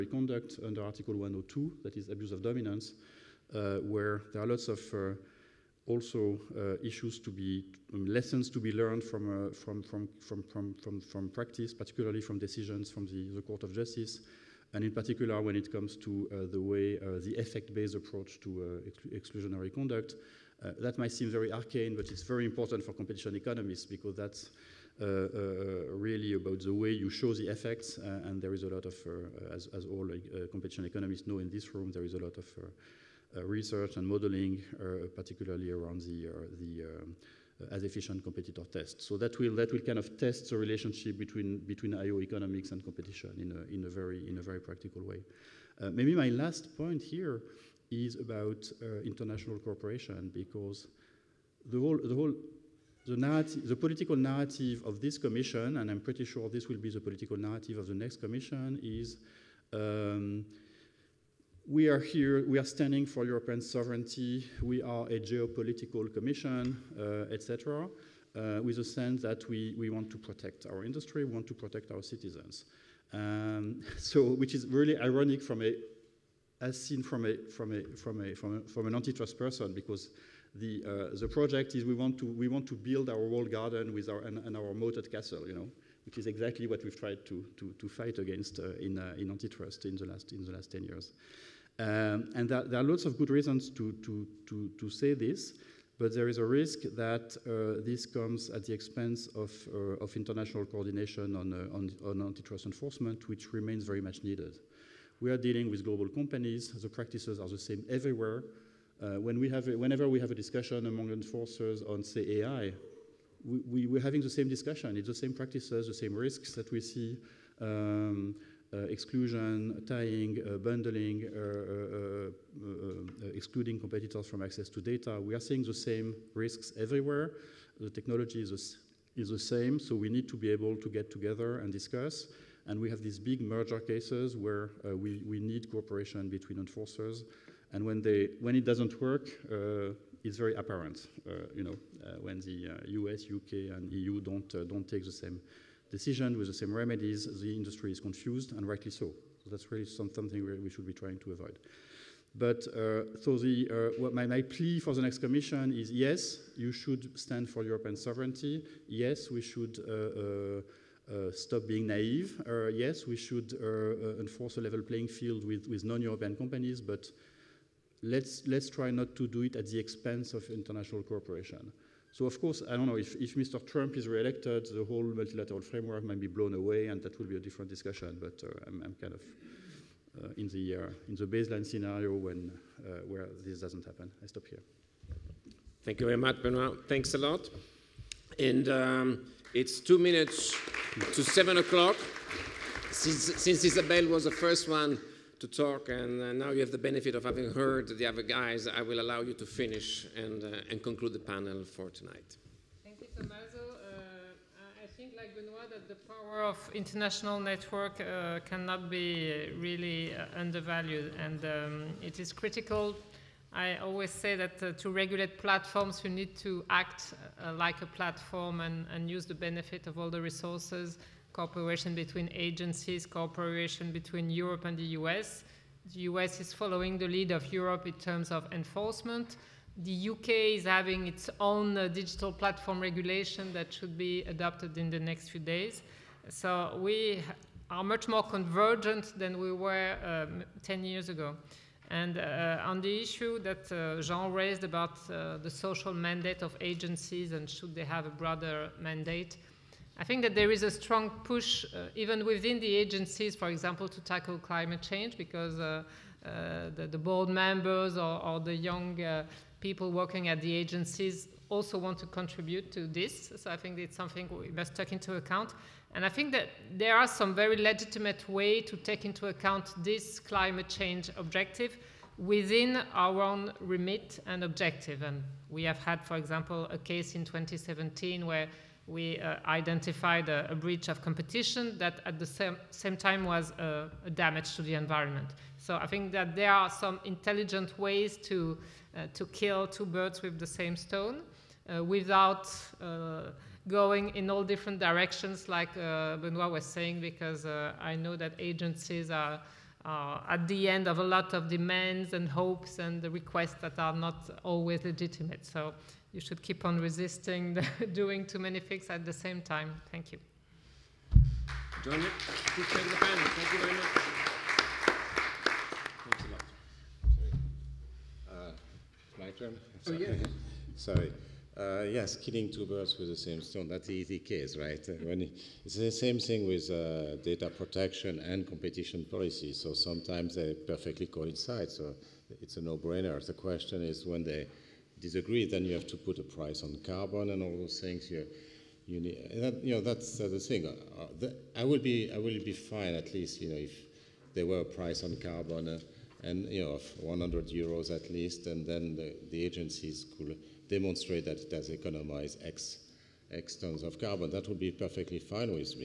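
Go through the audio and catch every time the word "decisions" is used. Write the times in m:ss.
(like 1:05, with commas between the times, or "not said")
0:12, 2:25.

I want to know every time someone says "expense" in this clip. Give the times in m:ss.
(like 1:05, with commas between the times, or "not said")
1:38, 2:49.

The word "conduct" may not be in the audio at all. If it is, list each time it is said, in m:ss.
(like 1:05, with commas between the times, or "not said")
0:00, 0:19.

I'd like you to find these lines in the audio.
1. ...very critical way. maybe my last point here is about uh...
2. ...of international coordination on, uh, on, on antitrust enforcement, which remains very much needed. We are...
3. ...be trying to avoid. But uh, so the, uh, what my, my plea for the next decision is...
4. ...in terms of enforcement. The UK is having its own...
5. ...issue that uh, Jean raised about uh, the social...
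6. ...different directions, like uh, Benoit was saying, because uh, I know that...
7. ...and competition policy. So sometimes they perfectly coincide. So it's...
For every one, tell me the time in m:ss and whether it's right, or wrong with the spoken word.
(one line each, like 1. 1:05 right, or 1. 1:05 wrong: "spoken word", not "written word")
1. 0:44 wrong: "practical", not "critical"
2. 1:40 right
3. 2:30 wrong: "commission", not "decision"
4. 3:47 right
5. 4:03 right
6. 4:54 right
7. 5:28 right.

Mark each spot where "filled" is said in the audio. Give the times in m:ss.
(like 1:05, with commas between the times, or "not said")
not said.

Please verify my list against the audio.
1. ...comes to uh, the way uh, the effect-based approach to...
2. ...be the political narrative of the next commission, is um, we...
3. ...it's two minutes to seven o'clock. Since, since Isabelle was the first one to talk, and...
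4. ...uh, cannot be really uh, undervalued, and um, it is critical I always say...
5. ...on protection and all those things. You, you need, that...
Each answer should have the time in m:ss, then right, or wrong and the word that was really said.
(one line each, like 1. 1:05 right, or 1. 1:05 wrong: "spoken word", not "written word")
1. 0:15 right
2. 0:56 right
3. 3:09 right
4. 3:27 right
5. 5:36 wrong: "carbon", not "protection".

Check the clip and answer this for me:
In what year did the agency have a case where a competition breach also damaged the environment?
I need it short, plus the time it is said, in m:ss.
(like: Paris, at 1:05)
2017, at 4:37.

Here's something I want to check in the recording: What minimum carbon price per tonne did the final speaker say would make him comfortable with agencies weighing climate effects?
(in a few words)
100 euros.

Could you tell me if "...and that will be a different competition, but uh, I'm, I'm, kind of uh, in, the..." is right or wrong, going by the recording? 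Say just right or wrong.
wrong.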